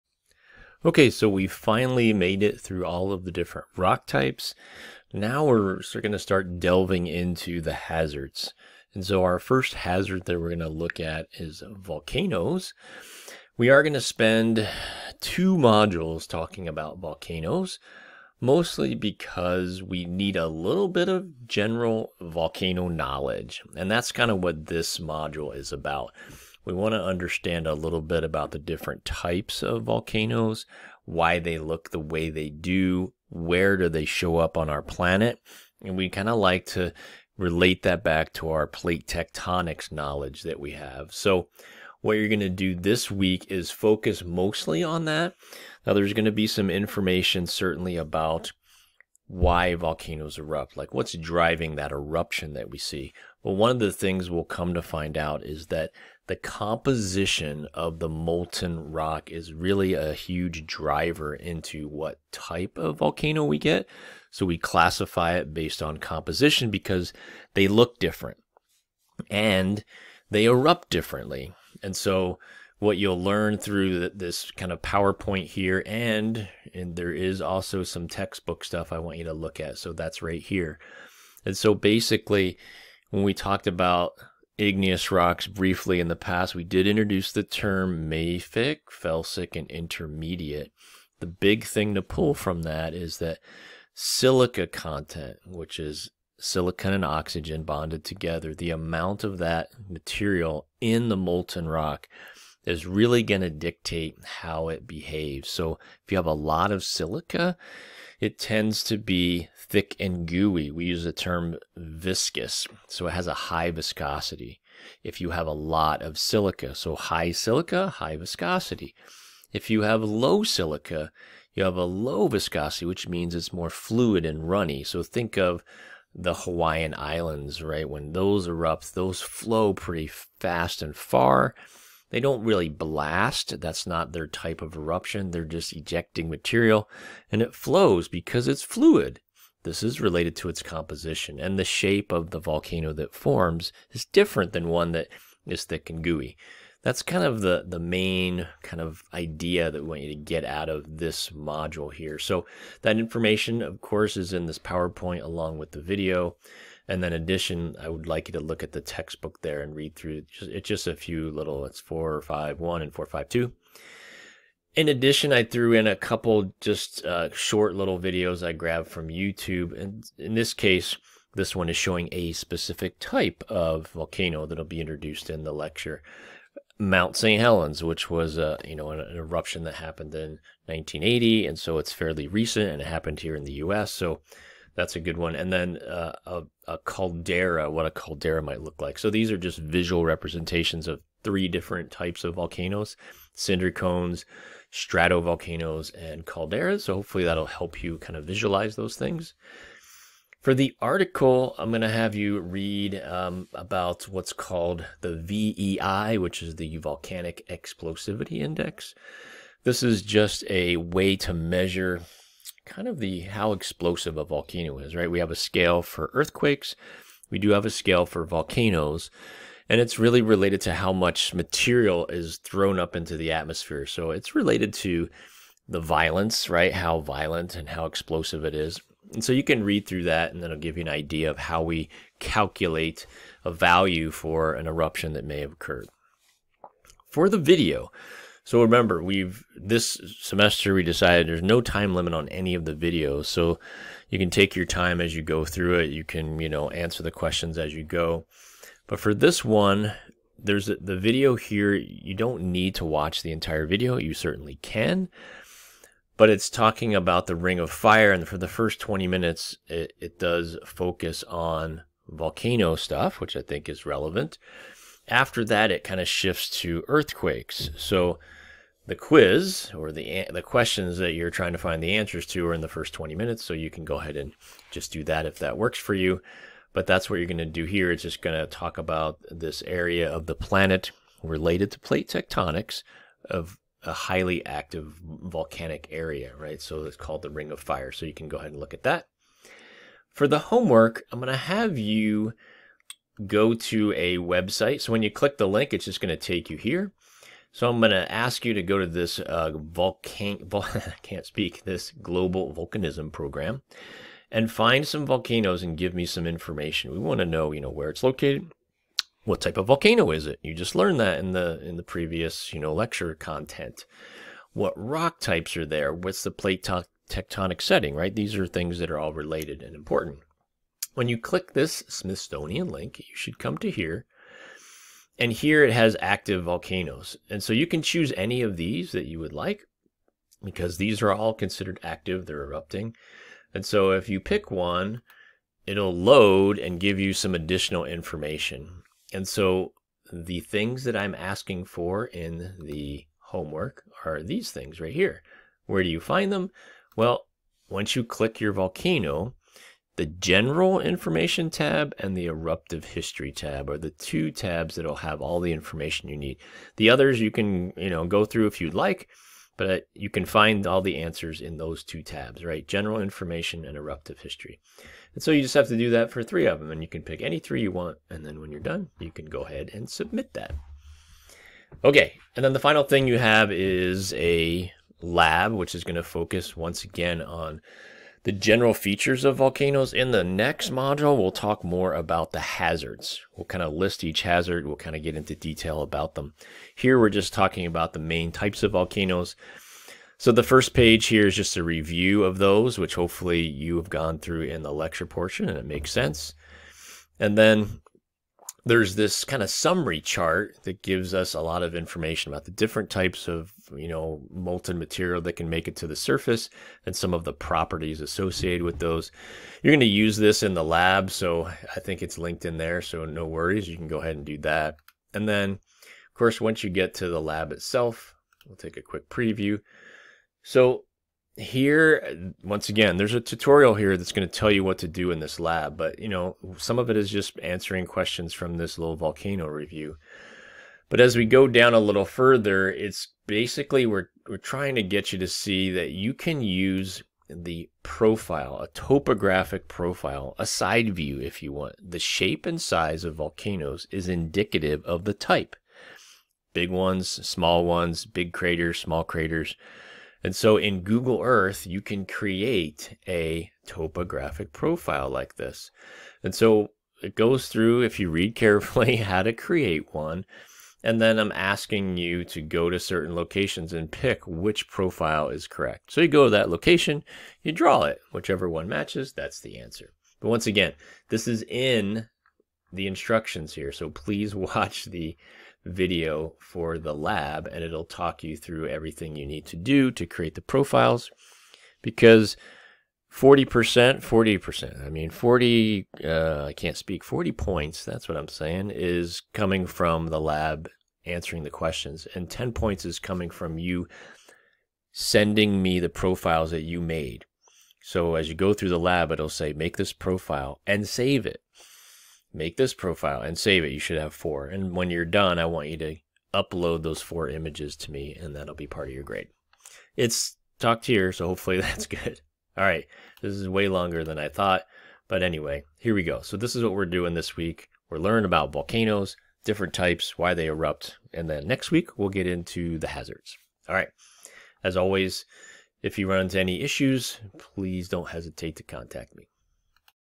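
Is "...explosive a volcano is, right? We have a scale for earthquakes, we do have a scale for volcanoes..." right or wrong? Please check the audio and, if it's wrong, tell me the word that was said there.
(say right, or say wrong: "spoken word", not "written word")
right.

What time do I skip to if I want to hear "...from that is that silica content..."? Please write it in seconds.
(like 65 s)
92 s.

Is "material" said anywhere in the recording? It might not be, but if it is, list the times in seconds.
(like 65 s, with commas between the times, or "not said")
99 s, 136 s, 221 s, 404 s.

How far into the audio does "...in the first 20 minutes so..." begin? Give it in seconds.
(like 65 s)
272 s.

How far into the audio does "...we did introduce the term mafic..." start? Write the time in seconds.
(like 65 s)
86 s.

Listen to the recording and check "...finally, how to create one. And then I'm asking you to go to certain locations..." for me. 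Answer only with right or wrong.
wrong.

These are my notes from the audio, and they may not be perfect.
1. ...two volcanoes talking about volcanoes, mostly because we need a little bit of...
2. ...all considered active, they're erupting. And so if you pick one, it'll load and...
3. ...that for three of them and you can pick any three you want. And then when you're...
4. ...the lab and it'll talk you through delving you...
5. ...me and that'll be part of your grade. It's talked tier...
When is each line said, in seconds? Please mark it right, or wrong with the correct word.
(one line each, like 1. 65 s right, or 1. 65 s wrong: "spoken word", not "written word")
1. 15 s wrong: "modules", not "volcanoes"
2. 331 s right
3. 365 s right
4. 476 s wrong: "everything", not "delving"
5. 507 s right.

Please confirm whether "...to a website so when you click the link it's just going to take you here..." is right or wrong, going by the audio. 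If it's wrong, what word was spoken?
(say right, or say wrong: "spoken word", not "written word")
right.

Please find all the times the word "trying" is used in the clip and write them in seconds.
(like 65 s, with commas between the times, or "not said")
271 s, 434 s.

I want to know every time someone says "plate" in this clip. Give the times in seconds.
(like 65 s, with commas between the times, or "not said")
38 s, 281 s, 316 s.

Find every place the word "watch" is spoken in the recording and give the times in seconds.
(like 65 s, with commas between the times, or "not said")
252 s, 474 s.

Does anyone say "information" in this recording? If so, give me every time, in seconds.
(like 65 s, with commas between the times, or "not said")
46 s, 152 s, 306 s, 337 s, 350 s, 355 s, 362 s, 401 s.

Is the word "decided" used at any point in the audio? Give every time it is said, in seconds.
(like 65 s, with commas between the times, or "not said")
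240 s.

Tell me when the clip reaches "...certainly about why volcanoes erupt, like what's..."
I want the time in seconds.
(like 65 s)
47 s.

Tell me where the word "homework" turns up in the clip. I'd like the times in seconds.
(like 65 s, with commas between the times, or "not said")
290 s, 343 s.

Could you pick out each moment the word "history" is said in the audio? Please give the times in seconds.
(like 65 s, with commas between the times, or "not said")
352 s, 364 s.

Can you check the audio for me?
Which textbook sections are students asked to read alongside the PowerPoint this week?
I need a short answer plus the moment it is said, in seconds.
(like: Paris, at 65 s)
4.5.1 and 4.5.2, at 161 s.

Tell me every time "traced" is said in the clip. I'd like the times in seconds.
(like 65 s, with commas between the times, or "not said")
not said.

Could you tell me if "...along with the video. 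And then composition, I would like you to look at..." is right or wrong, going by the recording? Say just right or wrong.
wrong.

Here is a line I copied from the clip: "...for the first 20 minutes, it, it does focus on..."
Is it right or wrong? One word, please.
right.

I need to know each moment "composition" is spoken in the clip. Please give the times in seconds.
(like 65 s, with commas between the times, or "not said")
56 s, 65 s, 140 s.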